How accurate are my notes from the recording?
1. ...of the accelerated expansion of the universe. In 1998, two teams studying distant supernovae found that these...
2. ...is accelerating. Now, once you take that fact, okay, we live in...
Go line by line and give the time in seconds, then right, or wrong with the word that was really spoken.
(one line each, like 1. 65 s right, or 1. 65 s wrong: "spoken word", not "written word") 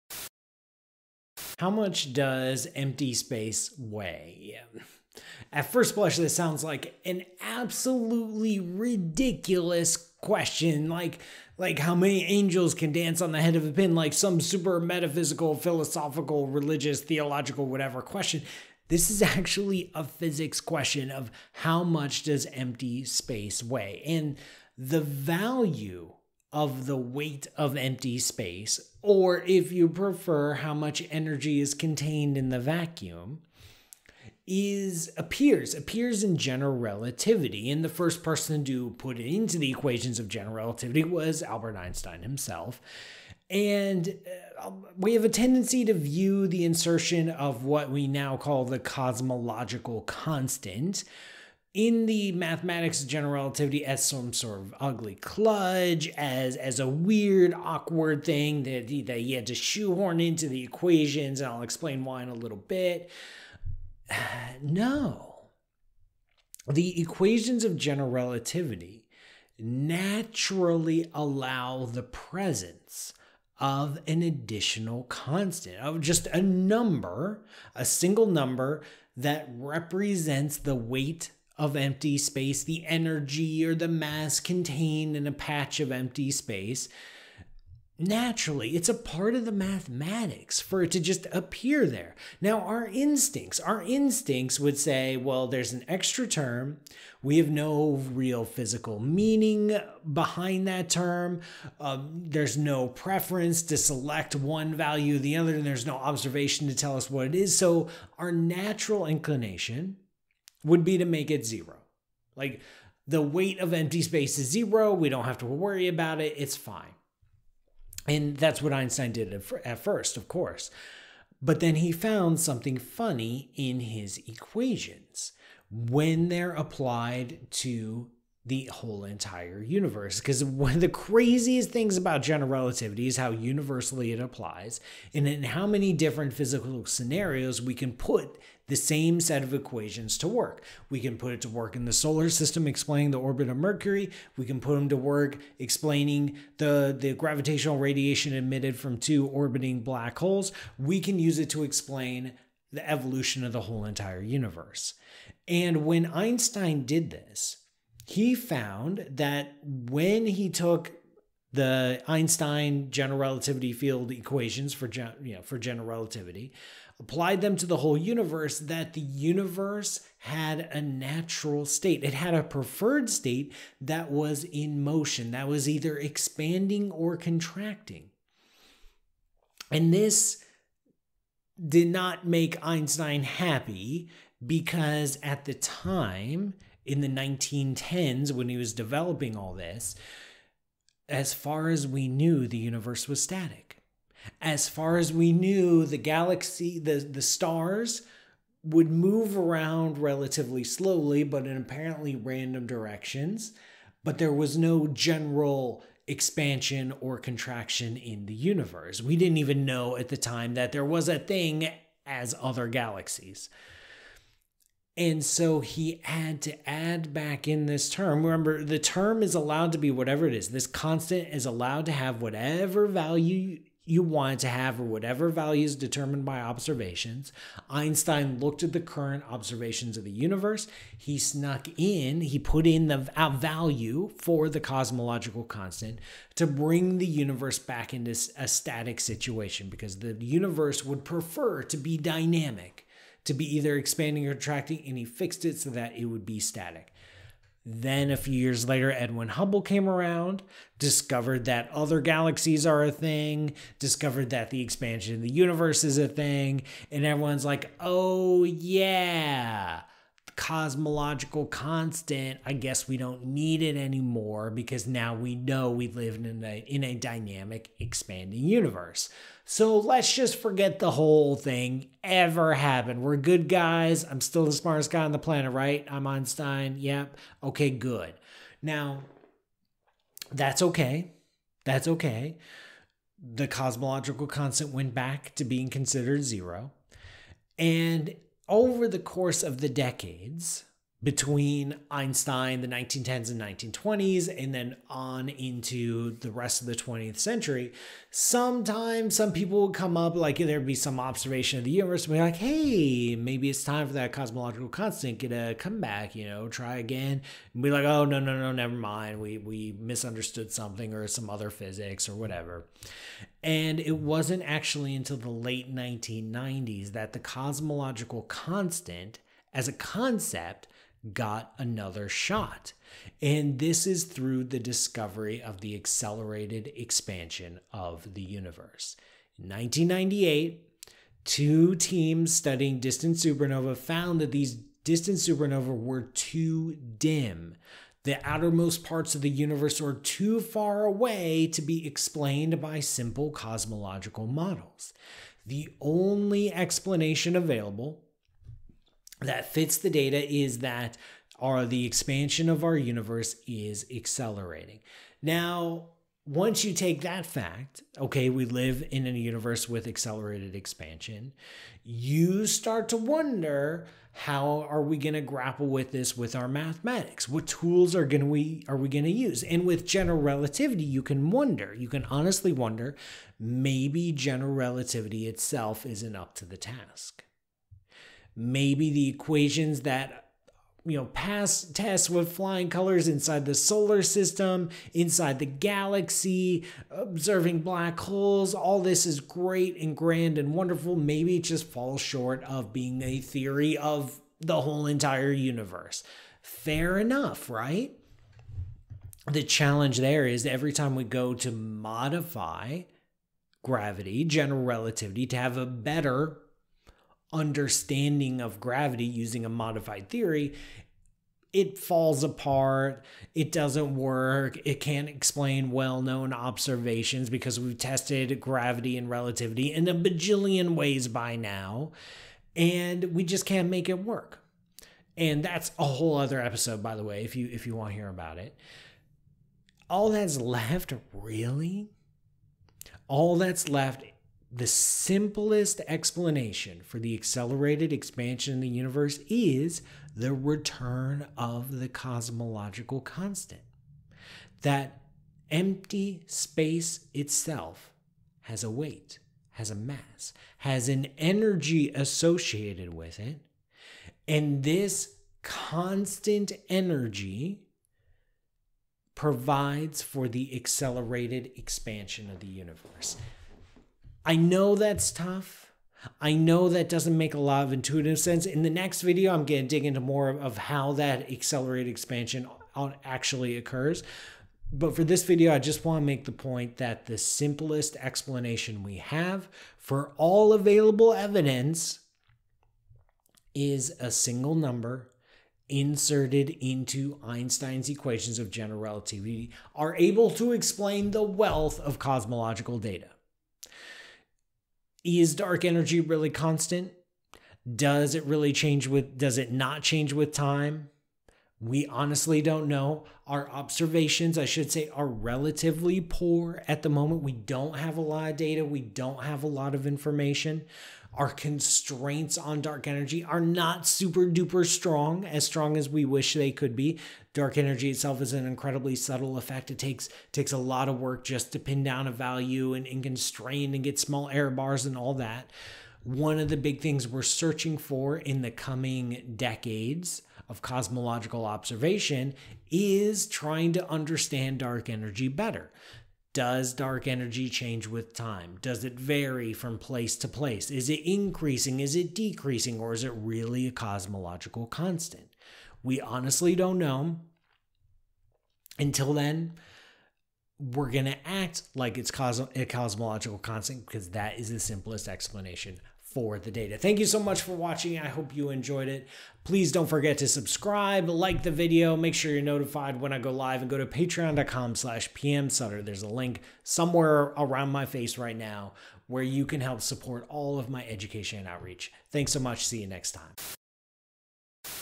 1. 325 s right
2. 353 s right.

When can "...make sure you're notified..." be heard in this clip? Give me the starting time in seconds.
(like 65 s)
561 s.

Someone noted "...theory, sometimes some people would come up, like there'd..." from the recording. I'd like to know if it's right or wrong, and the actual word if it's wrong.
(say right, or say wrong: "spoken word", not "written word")
wrong: "century", not "theory".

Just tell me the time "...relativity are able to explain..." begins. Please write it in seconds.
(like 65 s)
488 s.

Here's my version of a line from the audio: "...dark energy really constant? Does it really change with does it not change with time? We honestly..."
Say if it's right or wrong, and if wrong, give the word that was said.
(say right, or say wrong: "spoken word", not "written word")
right.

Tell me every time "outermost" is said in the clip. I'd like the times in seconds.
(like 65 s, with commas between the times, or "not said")
338 s.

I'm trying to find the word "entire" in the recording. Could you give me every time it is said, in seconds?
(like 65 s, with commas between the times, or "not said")
129 s, 153 s, 394 s.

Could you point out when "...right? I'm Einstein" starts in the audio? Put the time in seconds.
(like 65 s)
275 s.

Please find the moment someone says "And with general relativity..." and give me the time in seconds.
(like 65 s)
369 s.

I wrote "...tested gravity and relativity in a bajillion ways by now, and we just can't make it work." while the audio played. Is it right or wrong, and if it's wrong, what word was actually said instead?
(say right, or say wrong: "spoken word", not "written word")
right.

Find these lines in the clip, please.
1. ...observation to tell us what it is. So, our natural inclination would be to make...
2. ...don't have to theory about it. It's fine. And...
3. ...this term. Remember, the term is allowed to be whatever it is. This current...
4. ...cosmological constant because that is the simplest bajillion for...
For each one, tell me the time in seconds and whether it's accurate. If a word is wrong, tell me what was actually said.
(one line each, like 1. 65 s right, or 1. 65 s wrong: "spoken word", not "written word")
1. 105 s right
2. 115 s wrong: "worry", not "theory"
3. 217 s wrong: "constant", not "current"
4. 552 s wrong: "explanation", not "bajillion".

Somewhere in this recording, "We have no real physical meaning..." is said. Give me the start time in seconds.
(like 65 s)
97 s.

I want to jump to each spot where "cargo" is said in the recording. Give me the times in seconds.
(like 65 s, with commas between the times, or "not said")
not said.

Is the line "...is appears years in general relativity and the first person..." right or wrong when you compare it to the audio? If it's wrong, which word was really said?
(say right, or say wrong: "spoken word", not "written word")
wrong: "appears", not "years".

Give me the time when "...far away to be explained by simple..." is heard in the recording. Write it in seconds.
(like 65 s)
340 s.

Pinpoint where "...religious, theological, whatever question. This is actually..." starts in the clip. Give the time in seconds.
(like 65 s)
16 s.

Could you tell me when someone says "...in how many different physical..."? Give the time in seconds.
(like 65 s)
135 s.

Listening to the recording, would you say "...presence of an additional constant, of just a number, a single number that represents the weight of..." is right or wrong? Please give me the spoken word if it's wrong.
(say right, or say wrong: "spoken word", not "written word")
right.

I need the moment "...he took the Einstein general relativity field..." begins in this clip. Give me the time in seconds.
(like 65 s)
160 s.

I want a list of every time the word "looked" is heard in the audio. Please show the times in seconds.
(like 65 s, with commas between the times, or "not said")
228 s.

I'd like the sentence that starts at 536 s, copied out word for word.
Does dark energy change with time?